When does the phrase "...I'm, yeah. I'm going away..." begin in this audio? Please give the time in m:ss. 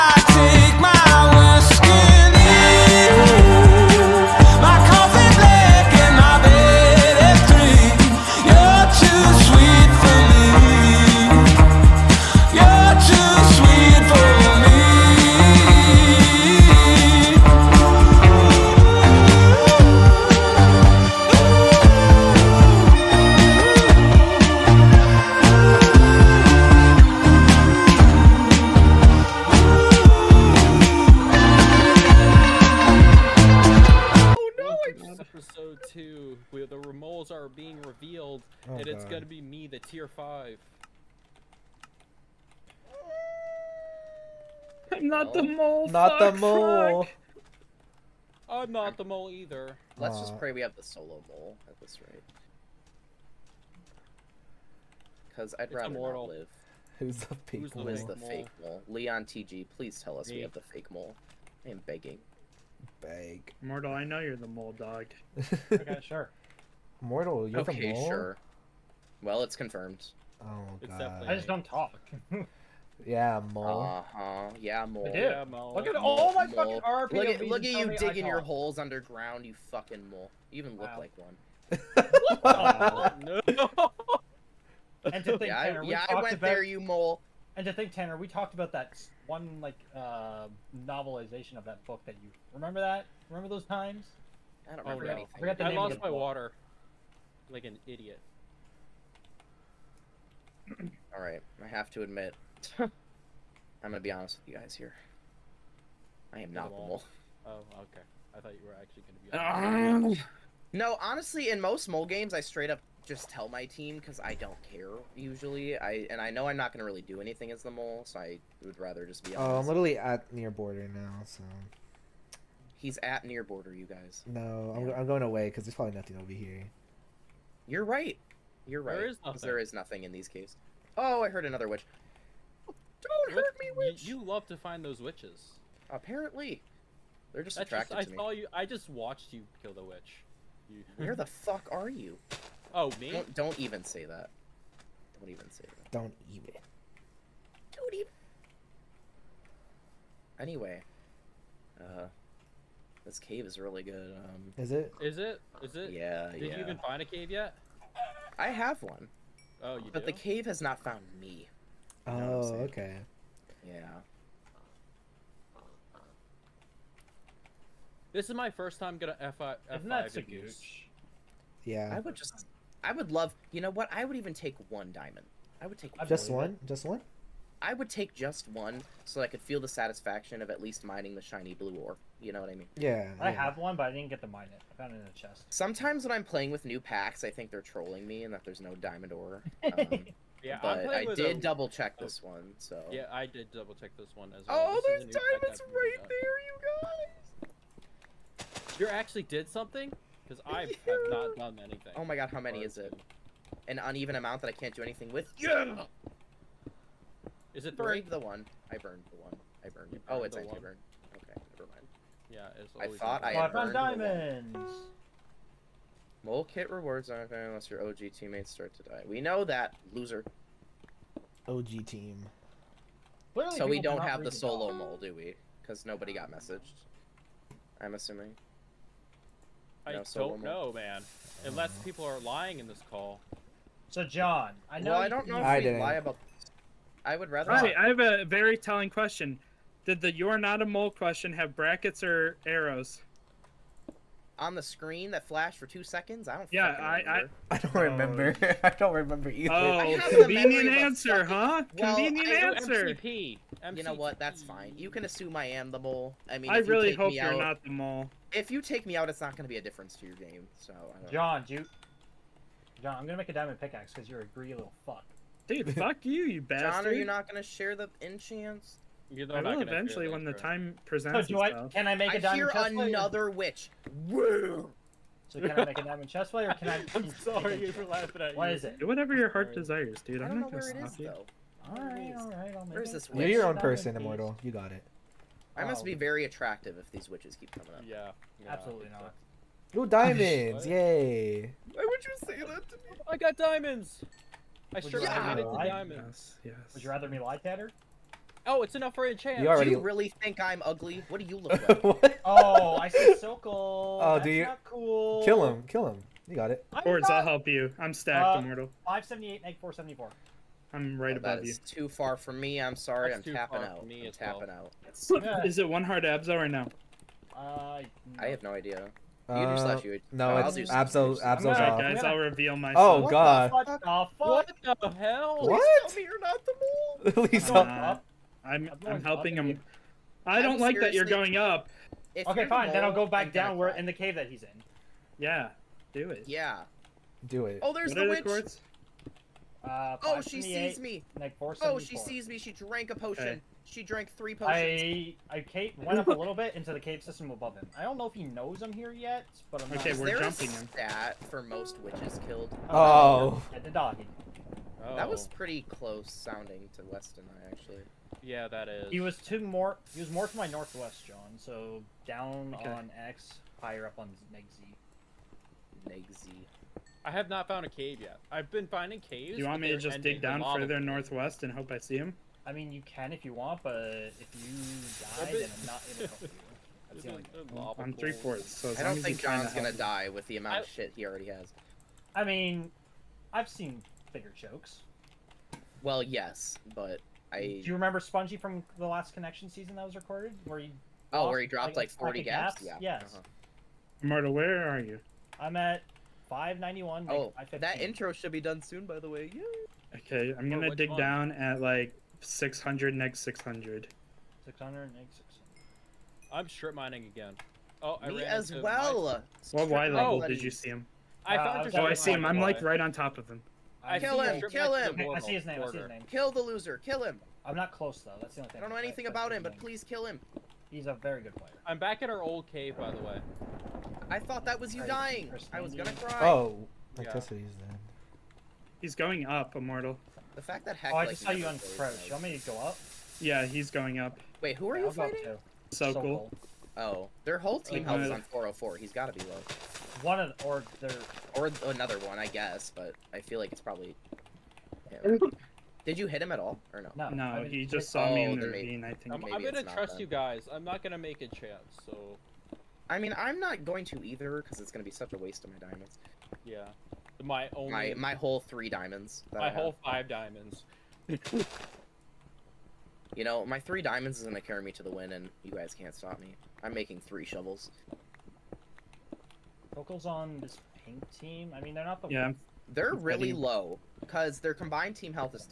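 2:04.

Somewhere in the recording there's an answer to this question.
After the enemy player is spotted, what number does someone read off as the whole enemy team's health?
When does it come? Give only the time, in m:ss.
7:18.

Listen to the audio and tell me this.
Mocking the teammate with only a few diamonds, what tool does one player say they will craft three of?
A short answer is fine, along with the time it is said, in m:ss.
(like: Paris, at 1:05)
Shovels, at 7:47.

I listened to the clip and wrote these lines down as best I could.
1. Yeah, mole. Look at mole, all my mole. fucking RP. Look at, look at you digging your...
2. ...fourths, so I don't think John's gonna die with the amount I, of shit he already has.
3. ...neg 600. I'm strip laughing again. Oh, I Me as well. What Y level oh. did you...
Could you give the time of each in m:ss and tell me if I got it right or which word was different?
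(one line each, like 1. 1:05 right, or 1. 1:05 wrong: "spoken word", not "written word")
1. 1:15 right
2. 6:18 right
3. 6:44 wrong: "mining", not "laughing".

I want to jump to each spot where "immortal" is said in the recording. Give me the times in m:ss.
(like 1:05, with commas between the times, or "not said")
4:43, 5:08, 7:09.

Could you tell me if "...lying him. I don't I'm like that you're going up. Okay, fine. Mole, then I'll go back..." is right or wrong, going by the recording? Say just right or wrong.
wrong.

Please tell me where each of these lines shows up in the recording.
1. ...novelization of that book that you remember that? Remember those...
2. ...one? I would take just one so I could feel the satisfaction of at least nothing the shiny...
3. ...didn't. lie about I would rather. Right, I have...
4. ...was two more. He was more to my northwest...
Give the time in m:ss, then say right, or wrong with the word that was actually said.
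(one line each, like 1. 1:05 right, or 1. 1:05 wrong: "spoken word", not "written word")
1. 1:30 right
2. 2:56 wrong: "mining", not "nothing"
3. 3:55 right
4. 5:59 right.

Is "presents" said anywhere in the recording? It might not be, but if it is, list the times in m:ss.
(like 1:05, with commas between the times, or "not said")
4:30.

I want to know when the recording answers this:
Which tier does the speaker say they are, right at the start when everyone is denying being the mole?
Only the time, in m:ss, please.
0:39.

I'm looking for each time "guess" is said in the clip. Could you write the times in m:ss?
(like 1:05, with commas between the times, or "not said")
7:07, 7:22.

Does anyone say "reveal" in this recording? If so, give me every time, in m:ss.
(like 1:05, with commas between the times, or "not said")
5:22.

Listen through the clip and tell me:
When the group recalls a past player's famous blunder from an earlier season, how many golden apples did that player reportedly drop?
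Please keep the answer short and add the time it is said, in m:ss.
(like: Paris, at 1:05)
40, at 6:31.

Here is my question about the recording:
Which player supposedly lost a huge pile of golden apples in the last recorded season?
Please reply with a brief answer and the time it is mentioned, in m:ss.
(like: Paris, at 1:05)
Spongy, at 6:27.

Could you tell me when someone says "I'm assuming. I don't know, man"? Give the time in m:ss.
3:47.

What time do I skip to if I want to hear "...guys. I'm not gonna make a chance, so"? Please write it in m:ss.
7:30.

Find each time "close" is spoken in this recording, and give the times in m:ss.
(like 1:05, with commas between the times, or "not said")
5:55, 6:57.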